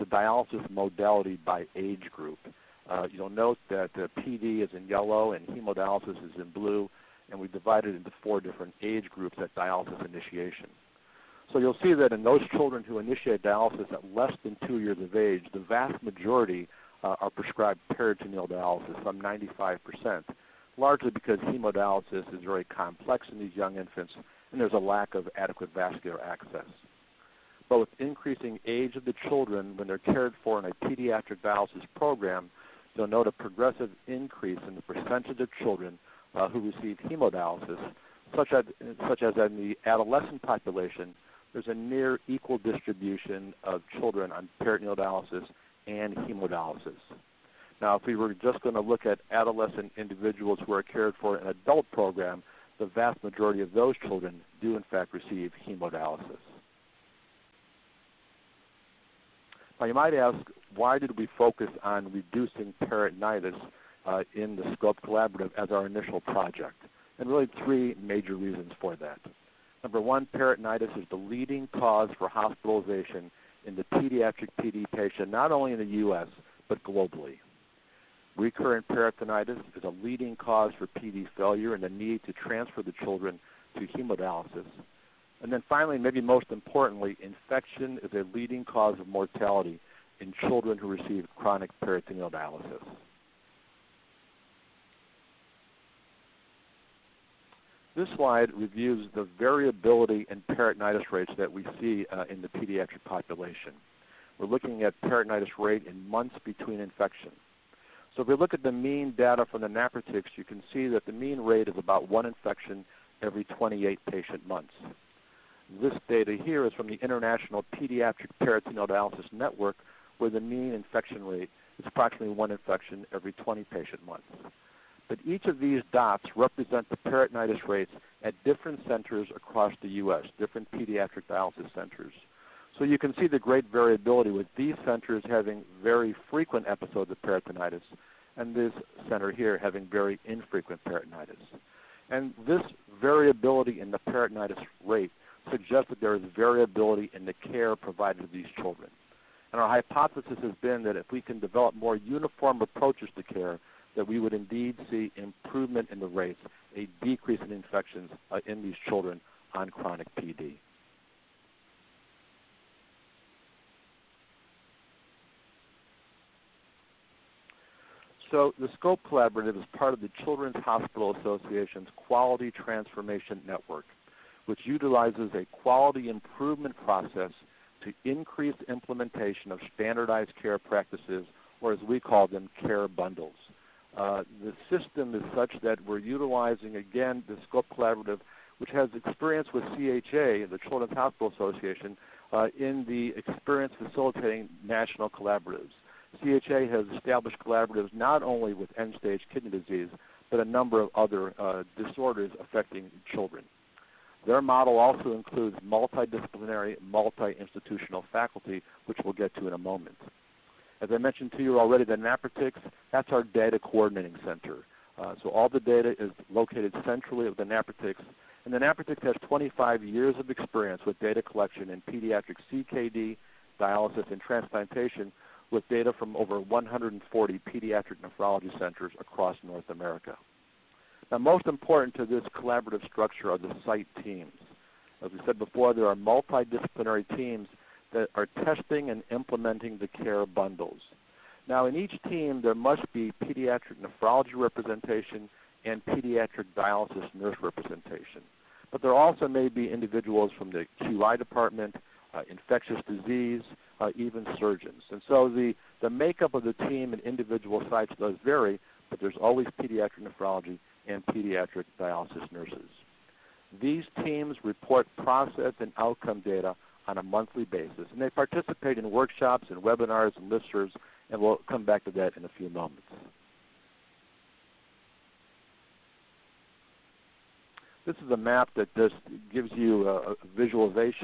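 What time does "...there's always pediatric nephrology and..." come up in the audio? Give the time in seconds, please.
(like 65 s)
258 s.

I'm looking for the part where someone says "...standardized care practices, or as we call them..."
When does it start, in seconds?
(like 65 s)
179 s.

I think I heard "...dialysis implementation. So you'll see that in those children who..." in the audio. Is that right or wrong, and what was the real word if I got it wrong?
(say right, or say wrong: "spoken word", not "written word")
wrong: "initiation", not "implementation".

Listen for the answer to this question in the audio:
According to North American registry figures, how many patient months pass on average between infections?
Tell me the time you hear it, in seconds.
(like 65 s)
113 s.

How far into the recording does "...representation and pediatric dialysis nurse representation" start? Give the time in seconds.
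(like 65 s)
244 s.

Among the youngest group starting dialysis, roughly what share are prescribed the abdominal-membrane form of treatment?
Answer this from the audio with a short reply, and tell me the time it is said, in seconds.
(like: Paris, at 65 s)
95%, at 19 s.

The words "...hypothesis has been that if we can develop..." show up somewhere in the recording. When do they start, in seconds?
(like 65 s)
149 s.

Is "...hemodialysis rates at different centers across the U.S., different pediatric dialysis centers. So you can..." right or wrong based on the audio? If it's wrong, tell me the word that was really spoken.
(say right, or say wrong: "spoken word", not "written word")
wrong: "peritonitis", not "hemodialysis".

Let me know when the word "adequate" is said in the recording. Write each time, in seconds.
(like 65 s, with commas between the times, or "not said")
25 s.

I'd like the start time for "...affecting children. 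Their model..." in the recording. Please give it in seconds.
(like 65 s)
202 s.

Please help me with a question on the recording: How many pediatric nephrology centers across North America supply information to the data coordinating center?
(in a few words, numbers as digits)
140.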